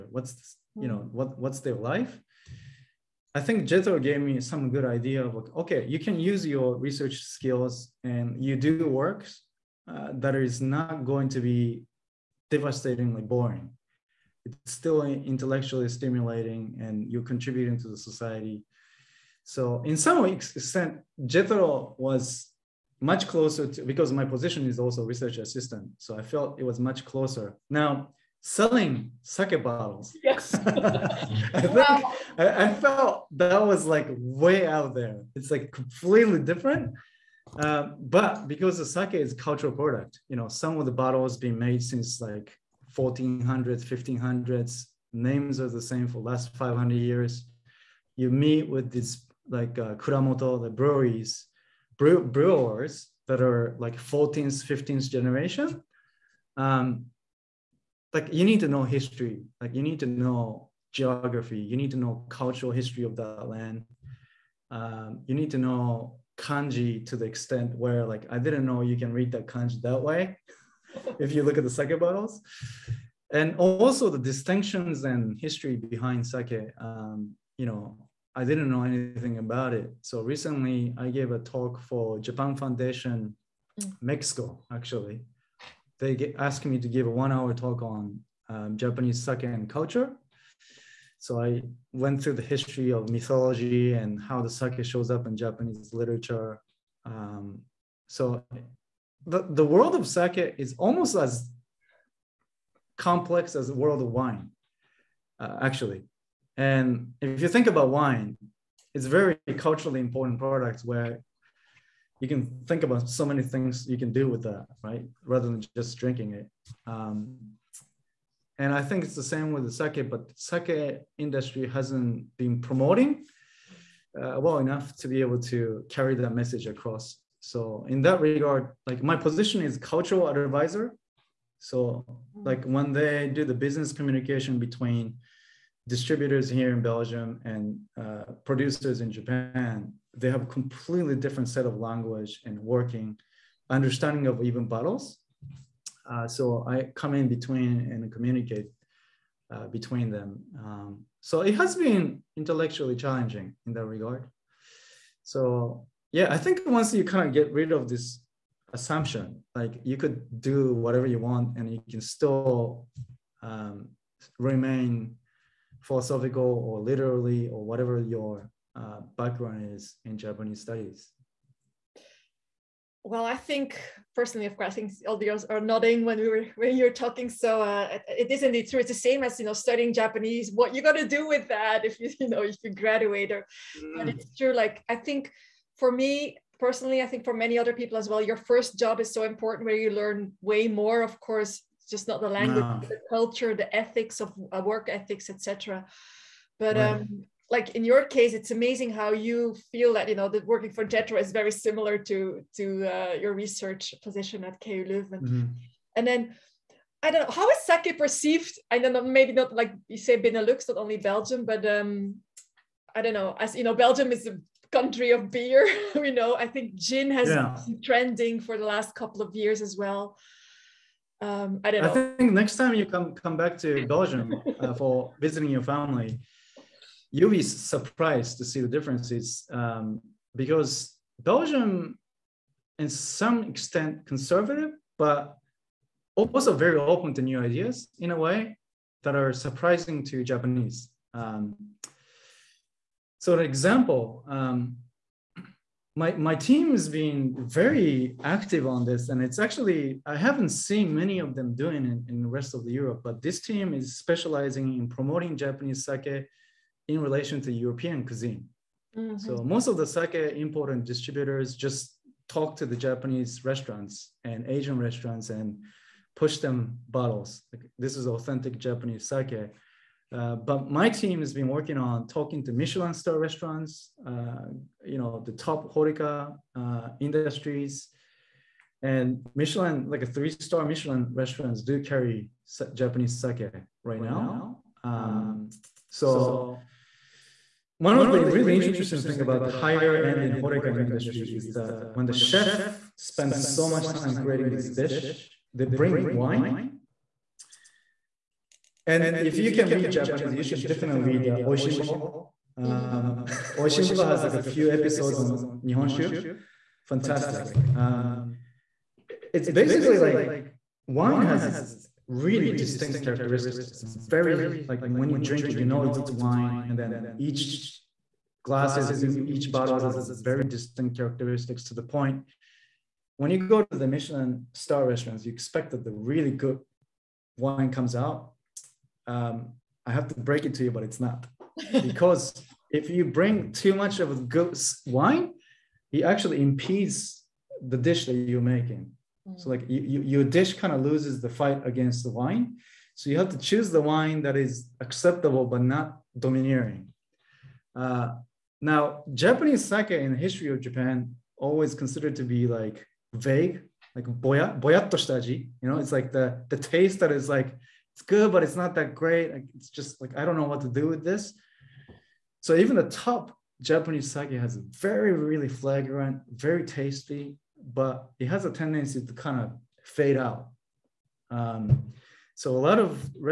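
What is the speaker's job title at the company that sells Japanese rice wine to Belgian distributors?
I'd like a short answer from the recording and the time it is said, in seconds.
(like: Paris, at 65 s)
Cultural advisor, at 129 s.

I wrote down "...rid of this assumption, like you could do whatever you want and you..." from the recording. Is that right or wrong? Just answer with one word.
right.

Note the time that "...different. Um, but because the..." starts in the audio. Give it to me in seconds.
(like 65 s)
36 s.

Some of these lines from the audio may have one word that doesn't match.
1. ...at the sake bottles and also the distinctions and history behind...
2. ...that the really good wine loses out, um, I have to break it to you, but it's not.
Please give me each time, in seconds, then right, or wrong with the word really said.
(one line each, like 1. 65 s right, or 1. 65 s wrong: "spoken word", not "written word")
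1. 71 s right
2. 325 s wrong: "comes", not "loses".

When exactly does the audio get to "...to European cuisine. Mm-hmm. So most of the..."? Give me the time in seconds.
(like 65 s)
257 s.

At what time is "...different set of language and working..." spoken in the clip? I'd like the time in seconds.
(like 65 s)
141 s.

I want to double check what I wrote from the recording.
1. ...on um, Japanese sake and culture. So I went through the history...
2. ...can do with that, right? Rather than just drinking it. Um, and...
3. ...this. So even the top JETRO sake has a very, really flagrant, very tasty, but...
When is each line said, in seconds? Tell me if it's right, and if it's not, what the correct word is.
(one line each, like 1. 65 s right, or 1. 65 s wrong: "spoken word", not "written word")
1. 87 s right
2. 113 s right
3. 361 s wrong: "Japanese", not "JETRO".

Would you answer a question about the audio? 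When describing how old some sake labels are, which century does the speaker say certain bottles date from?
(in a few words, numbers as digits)
1400s.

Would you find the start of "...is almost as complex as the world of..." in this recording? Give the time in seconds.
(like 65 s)
100 s.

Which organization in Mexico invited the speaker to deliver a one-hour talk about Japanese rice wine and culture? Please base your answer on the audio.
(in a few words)
Japan Foundation.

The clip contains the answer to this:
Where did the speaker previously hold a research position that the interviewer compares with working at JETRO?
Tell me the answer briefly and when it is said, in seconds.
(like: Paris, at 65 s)
KU Leuven, at 204 s.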